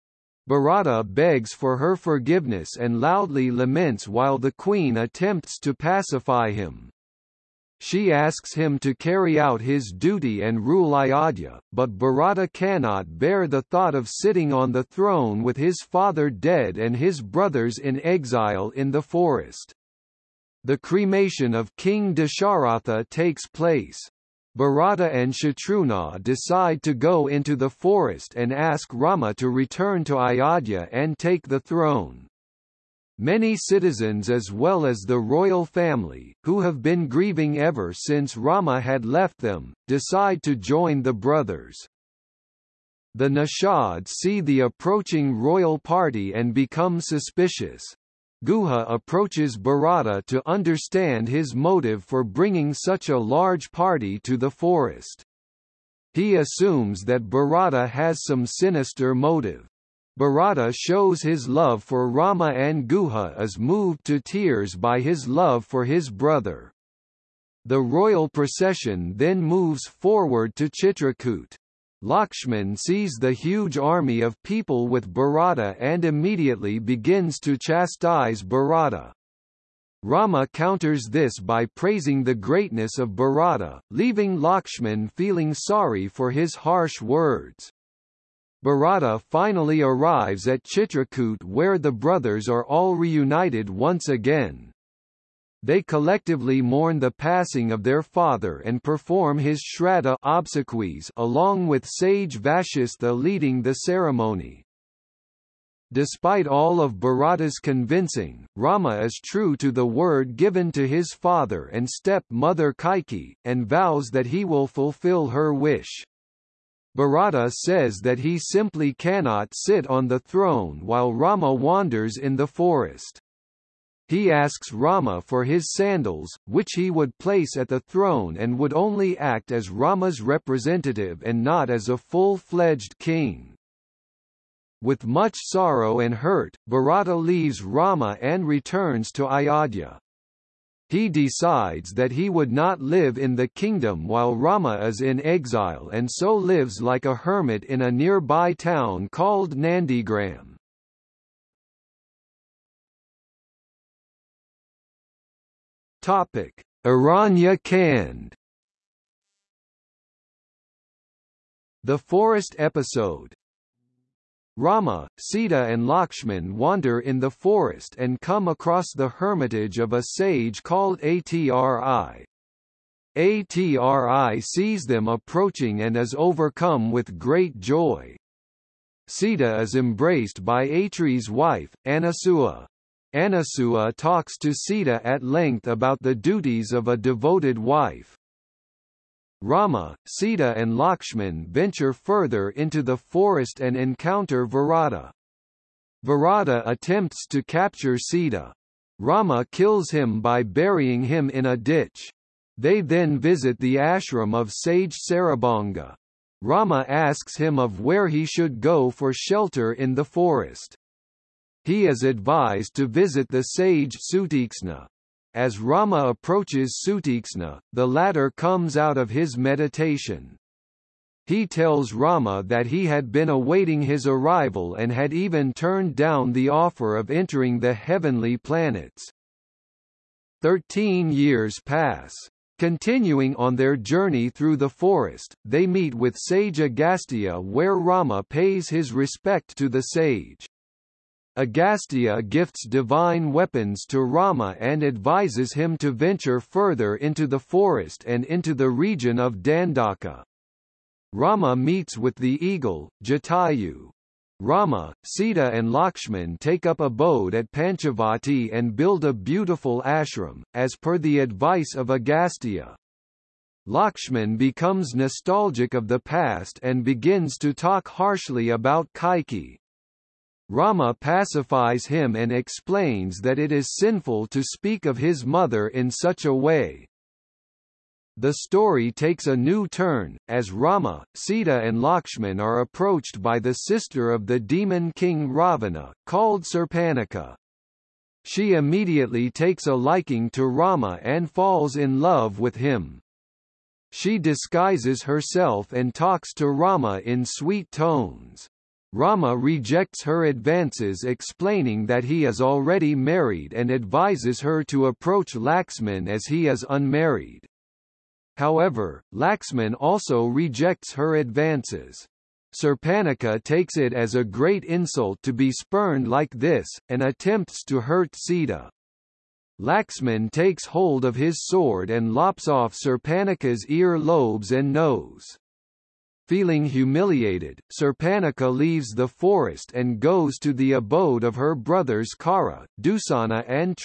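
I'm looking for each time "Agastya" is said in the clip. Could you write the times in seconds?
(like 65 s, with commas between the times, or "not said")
236 s, 241 s, 261 s.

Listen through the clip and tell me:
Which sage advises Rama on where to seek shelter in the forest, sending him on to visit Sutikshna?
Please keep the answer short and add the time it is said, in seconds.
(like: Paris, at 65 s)
Sarabhanga, at 205 s.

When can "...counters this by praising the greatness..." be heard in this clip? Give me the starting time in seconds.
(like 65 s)
80 s.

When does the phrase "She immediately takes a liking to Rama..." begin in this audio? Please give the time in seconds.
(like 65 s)
288 s.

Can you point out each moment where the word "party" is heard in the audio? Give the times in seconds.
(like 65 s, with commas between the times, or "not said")
45 s, 53 s.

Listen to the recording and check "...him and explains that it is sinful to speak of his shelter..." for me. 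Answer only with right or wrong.
wrong.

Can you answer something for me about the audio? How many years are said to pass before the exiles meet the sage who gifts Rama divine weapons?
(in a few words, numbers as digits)
13.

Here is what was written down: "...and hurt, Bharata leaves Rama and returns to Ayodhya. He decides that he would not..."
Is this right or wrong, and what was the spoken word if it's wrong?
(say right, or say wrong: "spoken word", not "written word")
right.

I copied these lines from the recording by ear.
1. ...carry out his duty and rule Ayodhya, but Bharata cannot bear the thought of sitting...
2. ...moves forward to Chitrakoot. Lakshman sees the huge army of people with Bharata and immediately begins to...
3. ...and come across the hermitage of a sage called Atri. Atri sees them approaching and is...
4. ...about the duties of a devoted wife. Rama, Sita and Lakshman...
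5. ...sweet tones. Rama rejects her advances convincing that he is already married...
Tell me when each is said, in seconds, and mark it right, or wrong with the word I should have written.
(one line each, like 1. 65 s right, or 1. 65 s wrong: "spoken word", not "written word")
1. 8 s right
2. 69 s right
3. 167 s right
4. 185 s right
5. 297 s wrong: "explaining", not "convincing".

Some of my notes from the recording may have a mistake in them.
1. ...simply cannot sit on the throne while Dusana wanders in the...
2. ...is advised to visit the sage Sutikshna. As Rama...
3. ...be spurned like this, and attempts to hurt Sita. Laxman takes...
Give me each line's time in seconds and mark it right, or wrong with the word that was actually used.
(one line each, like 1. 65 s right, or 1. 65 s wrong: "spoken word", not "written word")
1. 118 s wrong: "Rama", not "Dusana"
2. 211 s right
3. 315 s right.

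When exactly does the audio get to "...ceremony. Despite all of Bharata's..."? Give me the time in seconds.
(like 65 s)
103 s.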